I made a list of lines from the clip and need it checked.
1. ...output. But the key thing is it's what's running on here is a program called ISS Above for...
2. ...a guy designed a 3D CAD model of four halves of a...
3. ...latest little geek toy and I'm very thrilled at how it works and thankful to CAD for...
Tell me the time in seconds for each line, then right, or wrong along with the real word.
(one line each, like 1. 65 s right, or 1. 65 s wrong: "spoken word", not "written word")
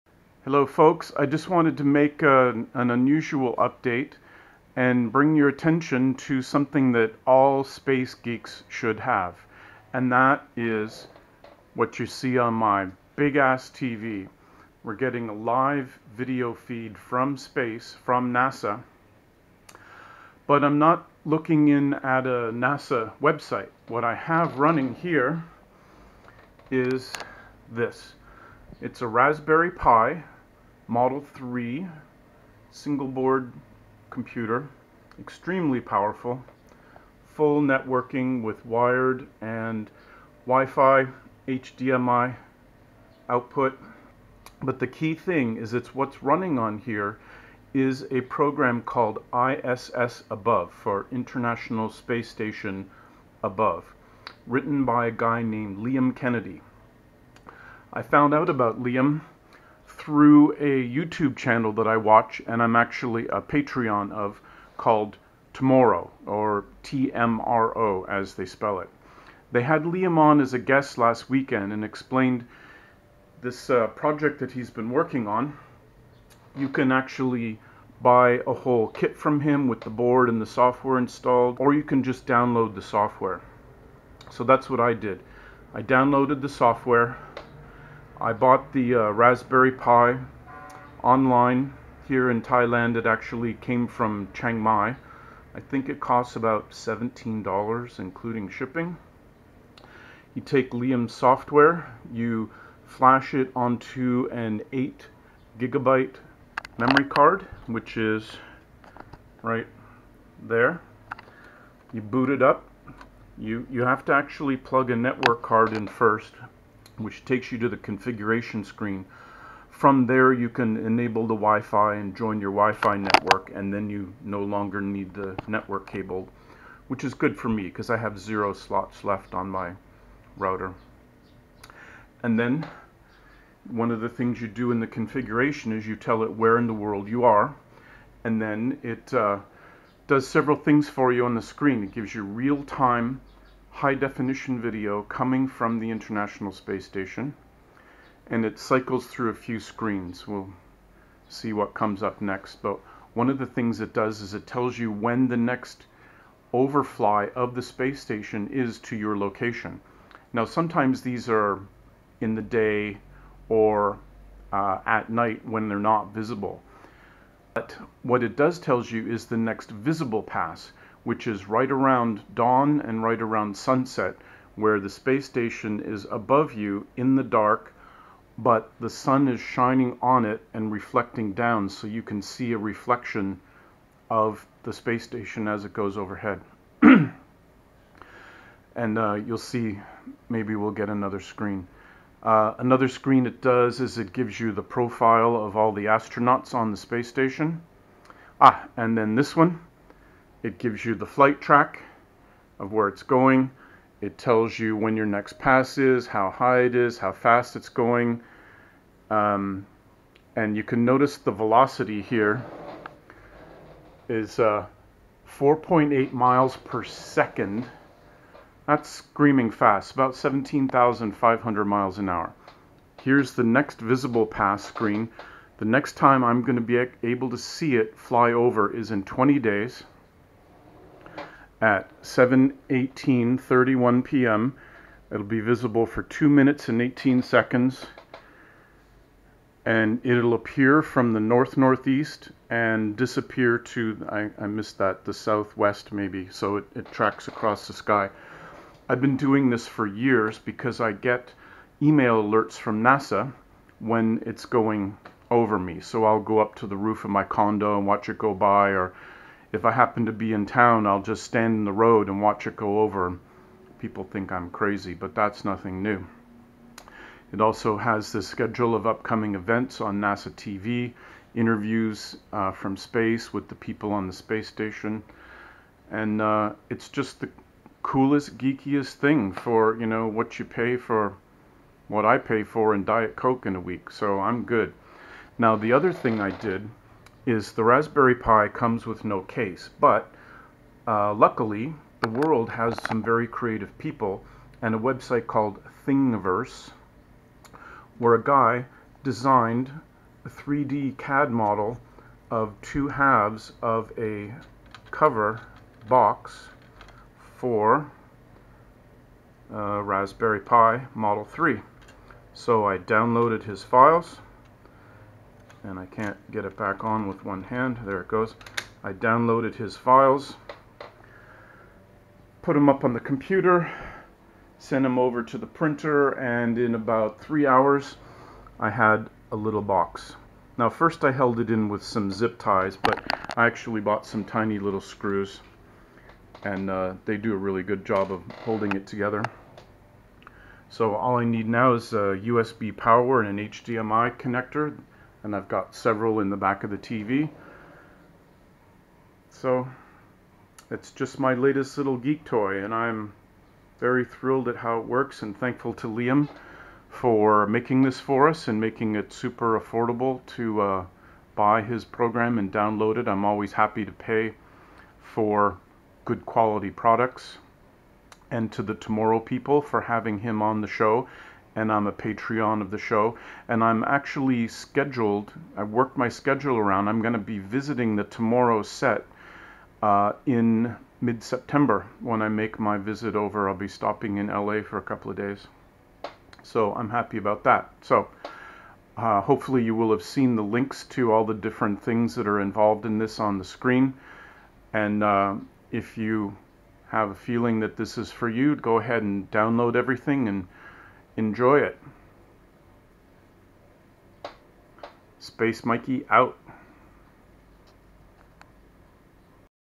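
1. 43 s right
2. 298 s wrong: "two", not "four"
3. 351 s wrong: "Liam", not "CAD".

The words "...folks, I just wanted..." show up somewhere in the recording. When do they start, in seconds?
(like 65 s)
0 s.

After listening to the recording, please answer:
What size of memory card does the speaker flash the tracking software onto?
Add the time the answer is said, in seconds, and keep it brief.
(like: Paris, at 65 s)
8 gigabytes, at 104 s.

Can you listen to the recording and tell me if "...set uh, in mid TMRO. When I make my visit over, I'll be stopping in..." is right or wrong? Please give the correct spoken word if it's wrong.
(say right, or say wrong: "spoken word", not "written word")
wrong: "September", not "TMRO".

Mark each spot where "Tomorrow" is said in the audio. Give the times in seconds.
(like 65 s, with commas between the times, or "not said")
65 s, 368 s, 378 s.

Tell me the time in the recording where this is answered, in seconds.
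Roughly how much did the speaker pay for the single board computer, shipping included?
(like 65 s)
96 s.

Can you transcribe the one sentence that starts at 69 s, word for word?
They had Liam on as a guest last weekend and explained this uh, project that he's been working on.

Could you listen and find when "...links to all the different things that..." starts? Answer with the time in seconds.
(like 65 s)
390 s.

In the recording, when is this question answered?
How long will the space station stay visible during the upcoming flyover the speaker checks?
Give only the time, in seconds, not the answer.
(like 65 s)
236 s.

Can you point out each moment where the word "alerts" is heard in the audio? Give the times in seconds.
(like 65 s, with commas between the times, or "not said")
252 s.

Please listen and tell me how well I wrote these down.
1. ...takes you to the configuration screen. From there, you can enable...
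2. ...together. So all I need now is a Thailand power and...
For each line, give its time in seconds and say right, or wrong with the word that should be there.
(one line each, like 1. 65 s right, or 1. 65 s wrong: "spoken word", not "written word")
1. 117 s right
2. 338 s wrong: "USB", not "Thailand".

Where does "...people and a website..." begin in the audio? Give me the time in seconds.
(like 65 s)
293 s.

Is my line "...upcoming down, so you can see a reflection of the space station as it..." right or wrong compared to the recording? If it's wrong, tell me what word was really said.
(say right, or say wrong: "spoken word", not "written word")
wrong: "reflecting", not "upcoming".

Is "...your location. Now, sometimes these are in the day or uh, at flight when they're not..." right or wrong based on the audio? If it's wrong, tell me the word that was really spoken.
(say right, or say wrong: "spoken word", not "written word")
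wrong: "night", not "flight".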